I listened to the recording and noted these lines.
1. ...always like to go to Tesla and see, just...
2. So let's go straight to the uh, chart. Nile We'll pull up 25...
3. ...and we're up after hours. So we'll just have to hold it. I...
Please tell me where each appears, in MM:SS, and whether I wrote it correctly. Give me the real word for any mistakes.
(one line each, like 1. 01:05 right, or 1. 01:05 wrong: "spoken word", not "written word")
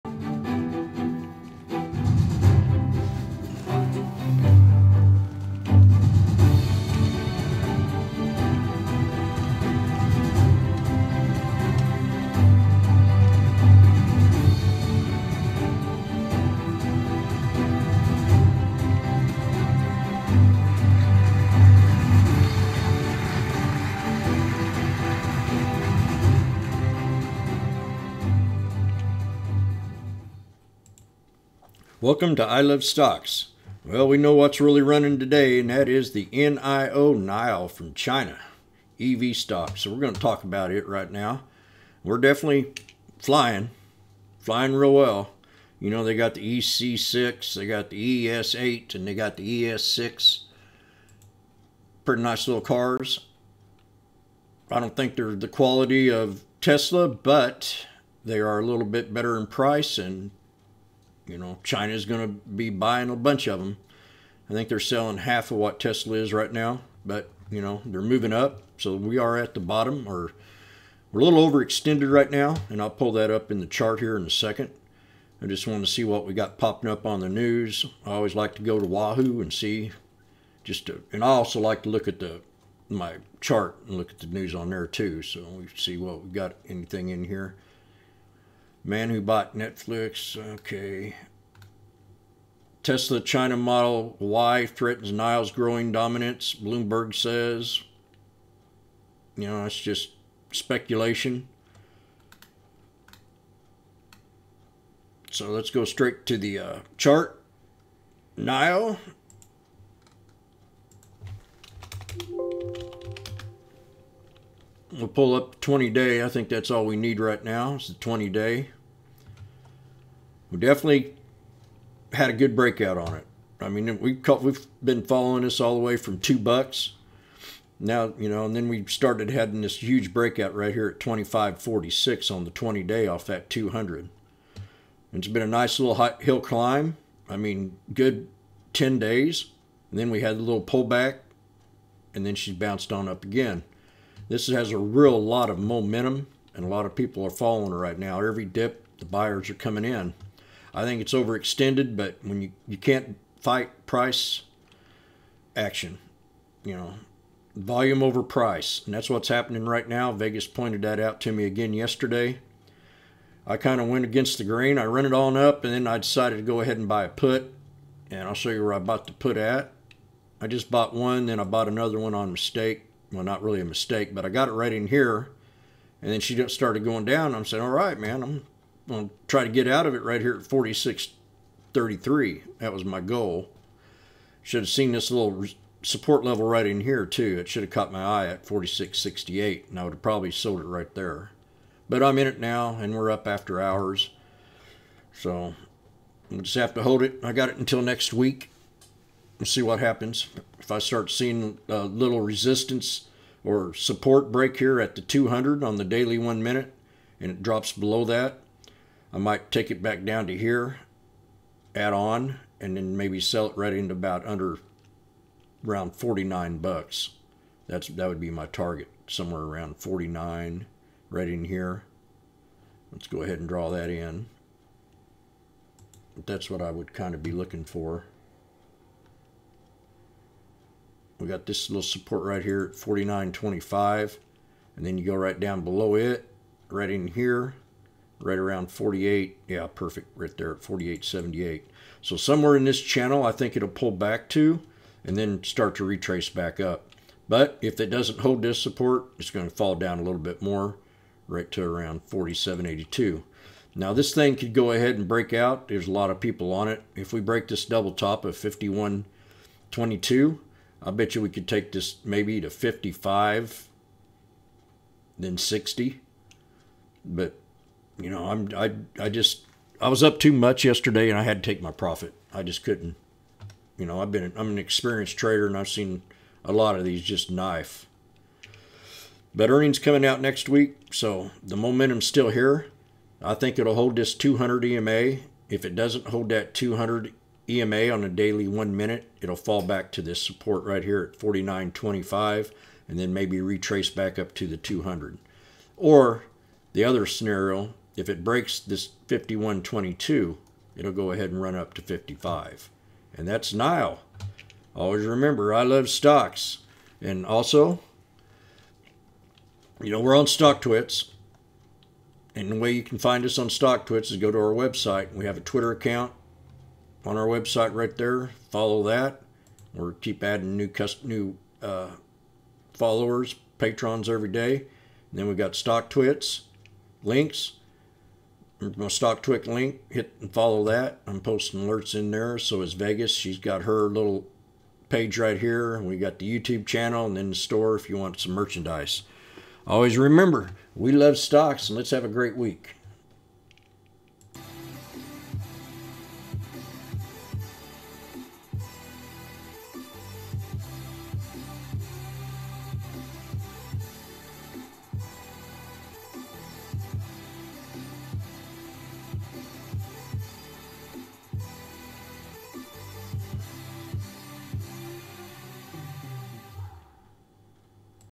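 1. 01:18 wrong: "Yahoo", not "Tesla"
2. 01:45 wrong: "20", not "25"
3. 03:12 right.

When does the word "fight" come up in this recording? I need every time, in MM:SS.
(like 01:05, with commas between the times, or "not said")
02:33.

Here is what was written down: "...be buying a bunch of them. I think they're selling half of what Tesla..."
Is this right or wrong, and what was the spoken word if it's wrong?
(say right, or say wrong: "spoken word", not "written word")
right.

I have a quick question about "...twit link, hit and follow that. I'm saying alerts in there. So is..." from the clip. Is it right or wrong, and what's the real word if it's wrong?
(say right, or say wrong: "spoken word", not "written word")
wrong: "posting", not "saying".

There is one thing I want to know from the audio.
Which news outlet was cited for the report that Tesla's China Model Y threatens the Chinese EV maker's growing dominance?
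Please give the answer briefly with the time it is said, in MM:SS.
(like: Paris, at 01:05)
Bloomberg, at 01:36.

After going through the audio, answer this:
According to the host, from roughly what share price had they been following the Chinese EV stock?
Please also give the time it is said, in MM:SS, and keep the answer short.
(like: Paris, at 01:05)
$2, at 02:06.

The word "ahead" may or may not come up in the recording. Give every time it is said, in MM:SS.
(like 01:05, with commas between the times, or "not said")
02:46, 03:43, 04:14, 05:01.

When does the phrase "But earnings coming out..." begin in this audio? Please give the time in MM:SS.
04:39.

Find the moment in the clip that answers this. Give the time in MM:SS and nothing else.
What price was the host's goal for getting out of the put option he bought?
03:00.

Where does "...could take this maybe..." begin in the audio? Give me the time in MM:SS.
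04:21.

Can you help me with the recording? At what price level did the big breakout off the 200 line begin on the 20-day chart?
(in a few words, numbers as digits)
25.46.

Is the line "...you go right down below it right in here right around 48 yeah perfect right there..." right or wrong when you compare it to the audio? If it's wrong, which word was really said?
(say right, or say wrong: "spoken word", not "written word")
right.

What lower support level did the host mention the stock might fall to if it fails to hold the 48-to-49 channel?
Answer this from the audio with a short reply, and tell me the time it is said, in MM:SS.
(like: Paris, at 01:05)
47.82, at 04:12.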